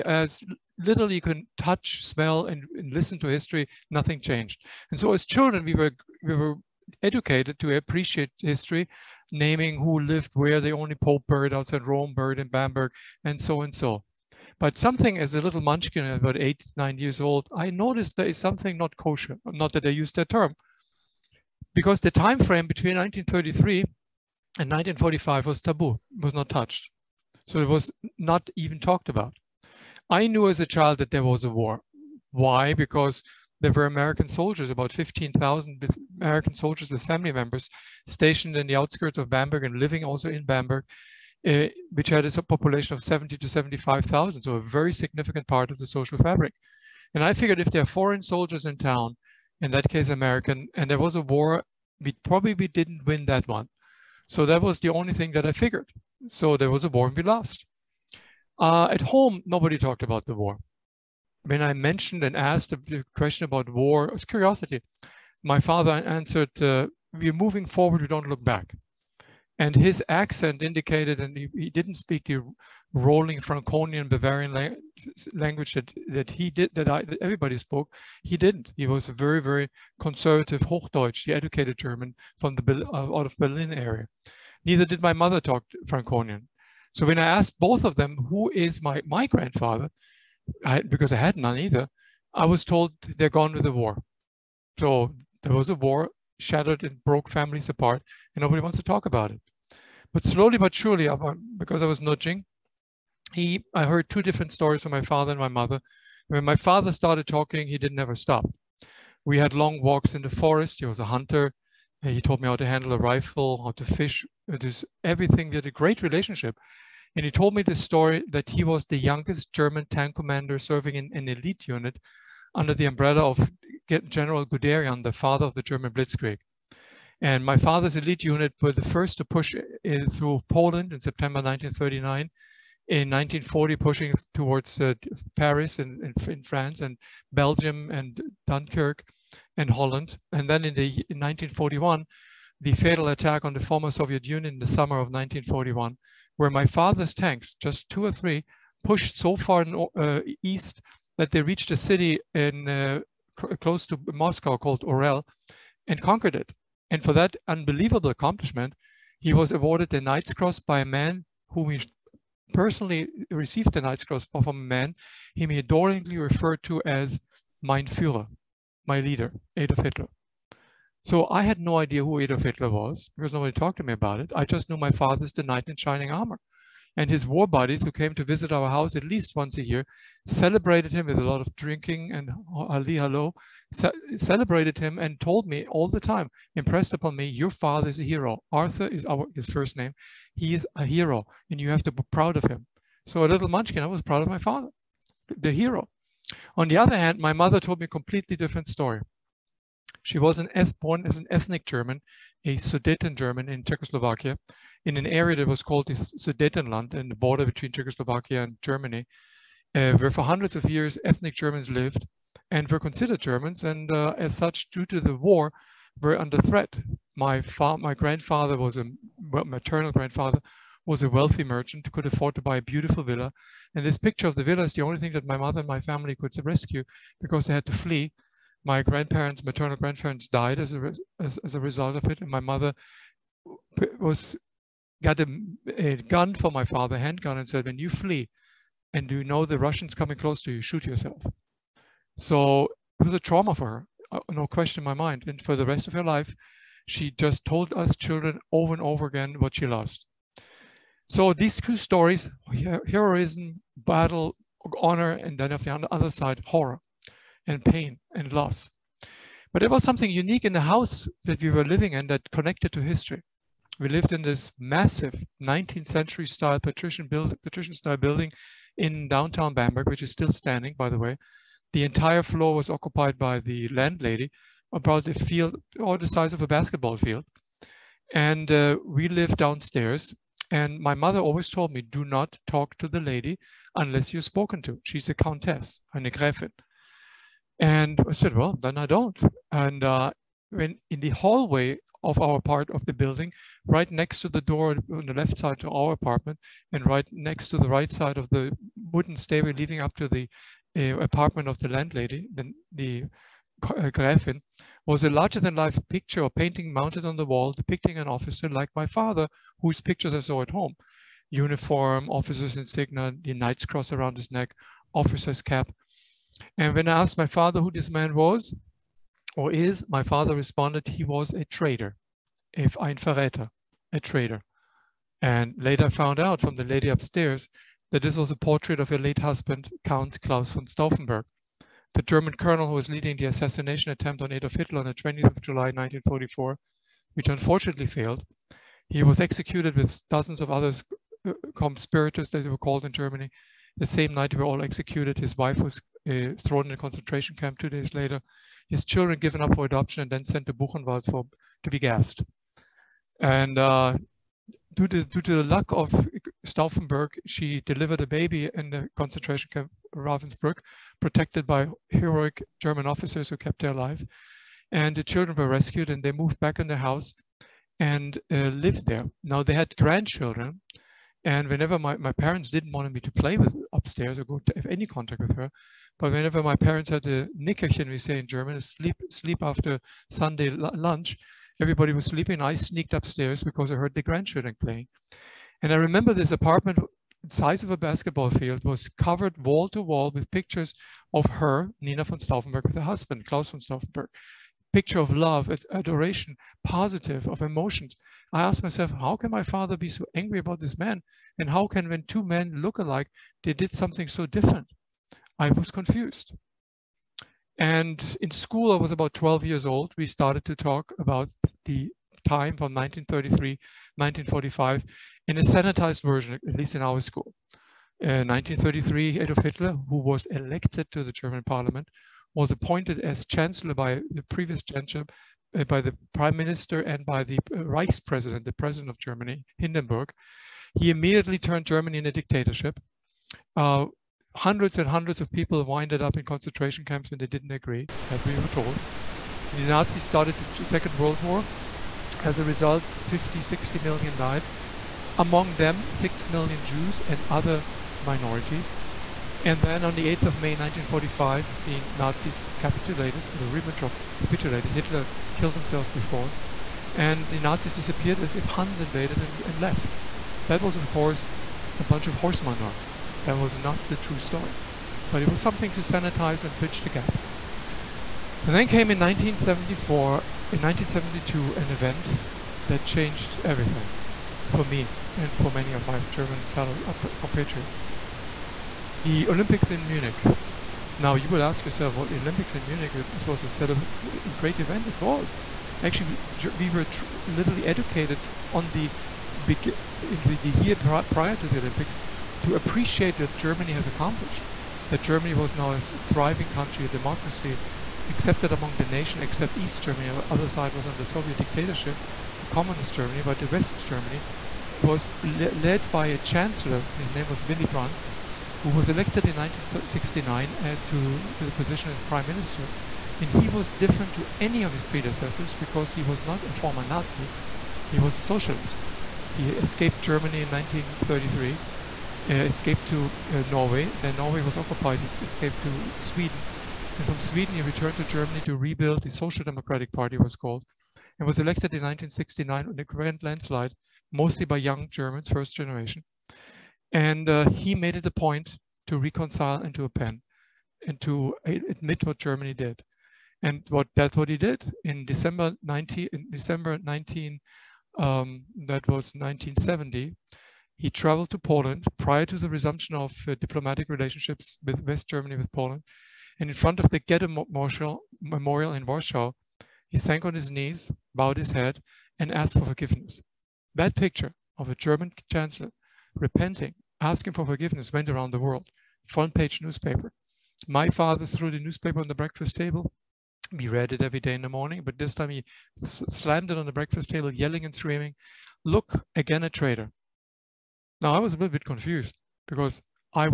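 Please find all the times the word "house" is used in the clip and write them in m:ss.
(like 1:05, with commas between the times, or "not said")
2:58, 4:20, 6:06.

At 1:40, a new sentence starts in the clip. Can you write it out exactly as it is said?
But slowly but surely, because I was nudging, he, I heard two different stories from my father and my mother.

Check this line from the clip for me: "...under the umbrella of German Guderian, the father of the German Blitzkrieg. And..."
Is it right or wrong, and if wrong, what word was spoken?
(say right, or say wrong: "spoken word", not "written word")
wrong: "General", not "German".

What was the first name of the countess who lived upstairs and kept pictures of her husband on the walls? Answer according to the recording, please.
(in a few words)
Nina.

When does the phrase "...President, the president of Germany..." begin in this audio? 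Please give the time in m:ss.
7:08.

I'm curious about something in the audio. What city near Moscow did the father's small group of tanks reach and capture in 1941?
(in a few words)
Orel.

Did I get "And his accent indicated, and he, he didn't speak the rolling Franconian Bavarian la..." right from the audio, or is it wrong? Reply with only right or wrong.
right.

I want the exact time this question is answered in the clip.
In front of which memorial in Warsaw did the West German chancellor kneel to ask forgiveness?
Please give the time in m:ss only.
9:16.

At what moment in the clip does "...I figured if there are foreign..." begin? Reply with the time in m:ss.
0:47.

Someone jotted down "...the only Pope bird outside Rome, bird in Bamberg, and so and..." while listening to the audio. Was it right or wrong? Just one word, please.
right.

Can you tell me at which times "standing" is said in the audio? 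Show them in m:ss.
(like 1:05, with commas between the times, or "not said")
4:30.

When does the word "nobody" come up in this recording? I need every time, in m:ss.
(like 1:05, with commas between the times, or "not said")
0:59, 1:38, 2:53.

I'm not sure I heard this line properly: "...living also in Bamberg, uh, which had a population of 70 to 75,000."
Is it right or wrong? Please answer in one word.
right.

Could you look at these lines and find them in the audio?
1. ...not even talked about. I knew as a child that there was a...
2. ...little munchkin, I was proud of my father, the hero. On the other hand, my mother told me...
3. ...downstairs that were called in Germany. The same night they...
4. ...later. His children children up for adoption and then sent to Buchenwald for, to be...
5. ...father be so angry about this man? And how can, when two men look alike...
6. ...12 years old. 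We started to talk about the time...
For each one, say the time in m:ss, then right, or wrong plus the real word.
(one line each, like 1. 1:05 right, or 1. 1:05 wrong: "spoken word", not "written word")
1. 0:28 right
2. 3:13 right
3. 5:41 wrong: "conspirators", not "downstairs"
4. 5:47 wrong: "given", not "children"
5. 6:39 right
6. 6:49 right.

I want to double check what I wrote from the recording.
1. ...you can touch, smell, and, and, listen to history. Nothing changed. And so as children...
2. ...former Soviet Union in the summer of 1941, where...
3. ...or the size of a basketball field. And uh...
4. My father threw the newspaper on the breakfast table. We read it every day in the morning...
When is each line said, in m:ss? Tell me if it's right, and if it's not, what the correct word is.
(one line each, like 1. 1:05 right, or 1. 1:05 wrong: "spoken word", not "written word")
1. 0:01 right
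2. 2:23 right
3. 4:35 right
4. 9:30 right.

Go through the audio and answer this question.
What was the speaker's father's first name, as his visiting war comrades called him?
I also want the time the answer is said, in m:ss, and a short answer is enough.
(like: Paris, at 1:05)
Arthur, at 3:08.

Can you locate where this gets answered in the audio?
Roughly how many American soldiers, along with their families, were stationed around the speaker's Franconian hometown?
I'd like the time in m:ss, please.
0:34.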